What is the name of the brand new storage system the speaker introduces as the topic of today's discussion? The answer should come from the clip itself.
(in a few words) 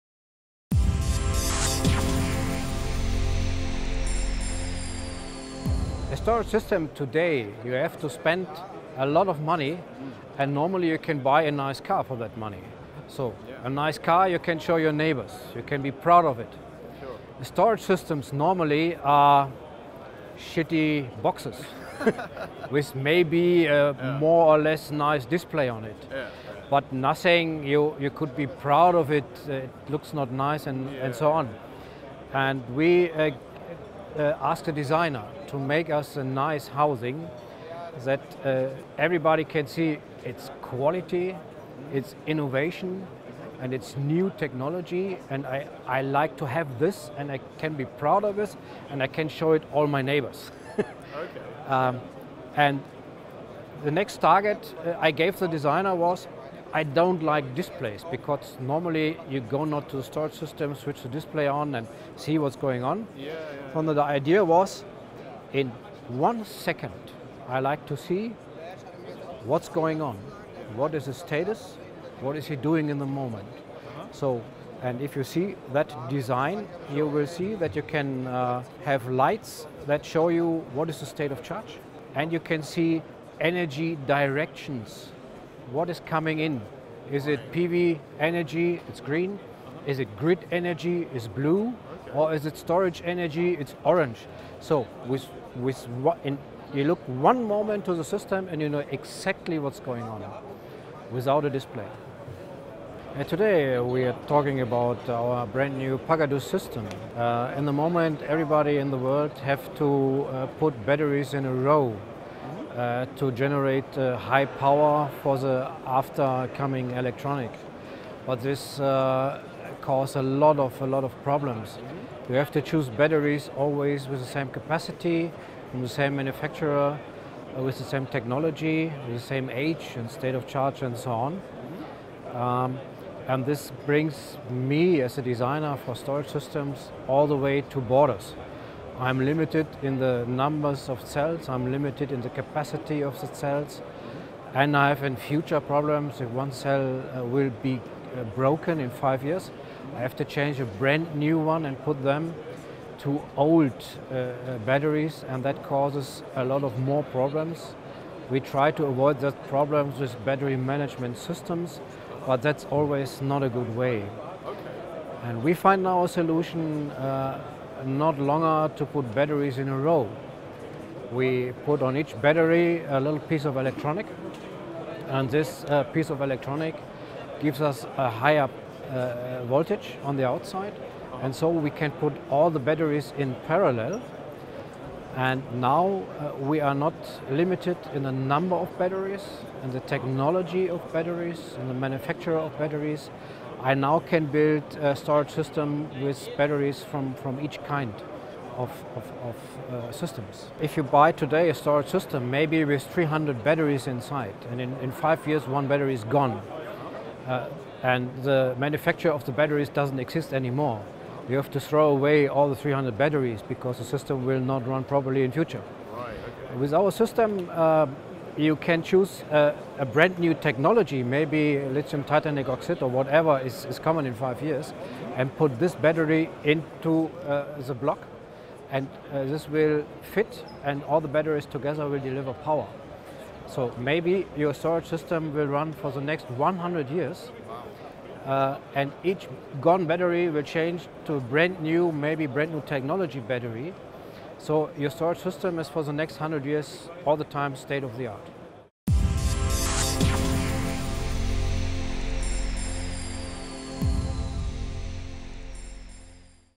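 Pagadu.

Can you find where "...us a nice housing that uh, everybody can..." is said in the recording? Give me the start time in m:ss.
0:35.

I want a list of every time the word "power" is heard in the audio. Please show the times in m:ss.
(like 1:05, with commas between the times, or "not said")
1:54, 3:52.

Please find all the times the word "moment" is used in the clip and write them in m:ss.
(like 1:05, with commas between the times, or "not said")
1:13, 1:37, 1:47.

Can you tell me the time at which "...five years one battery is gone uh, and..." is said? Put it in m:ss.
3:24.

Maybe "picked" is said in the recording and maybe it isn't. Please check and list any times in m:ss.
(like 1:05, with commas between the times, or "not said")
not said.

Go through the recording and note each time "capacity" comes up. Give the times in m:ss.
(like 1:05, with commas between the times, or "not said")
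2:04, 2:22.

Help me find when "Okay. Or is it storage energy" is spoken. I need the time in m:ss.
1:32.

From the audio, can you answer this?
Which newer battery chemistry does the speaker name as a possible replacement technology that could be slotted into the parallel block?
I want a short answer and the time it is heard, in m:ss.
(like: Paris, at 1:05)
Lithium titanate oxide, at 3:41.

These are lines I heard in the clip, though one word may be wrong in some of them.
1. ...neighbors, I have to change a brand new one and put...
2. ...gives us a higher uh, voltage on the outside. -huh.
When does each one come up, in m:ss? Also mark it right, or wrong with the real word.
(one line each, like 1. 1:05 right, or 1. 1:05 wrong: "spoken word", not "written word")
1. 2:29 wrong: "years", not "neighbors"
2. 2:57 right.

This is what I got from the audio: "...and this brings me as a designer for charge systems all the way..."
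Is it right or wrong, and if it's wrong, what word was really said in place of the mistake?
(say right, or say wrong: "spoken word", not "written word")
wrong: "storage", not "charge".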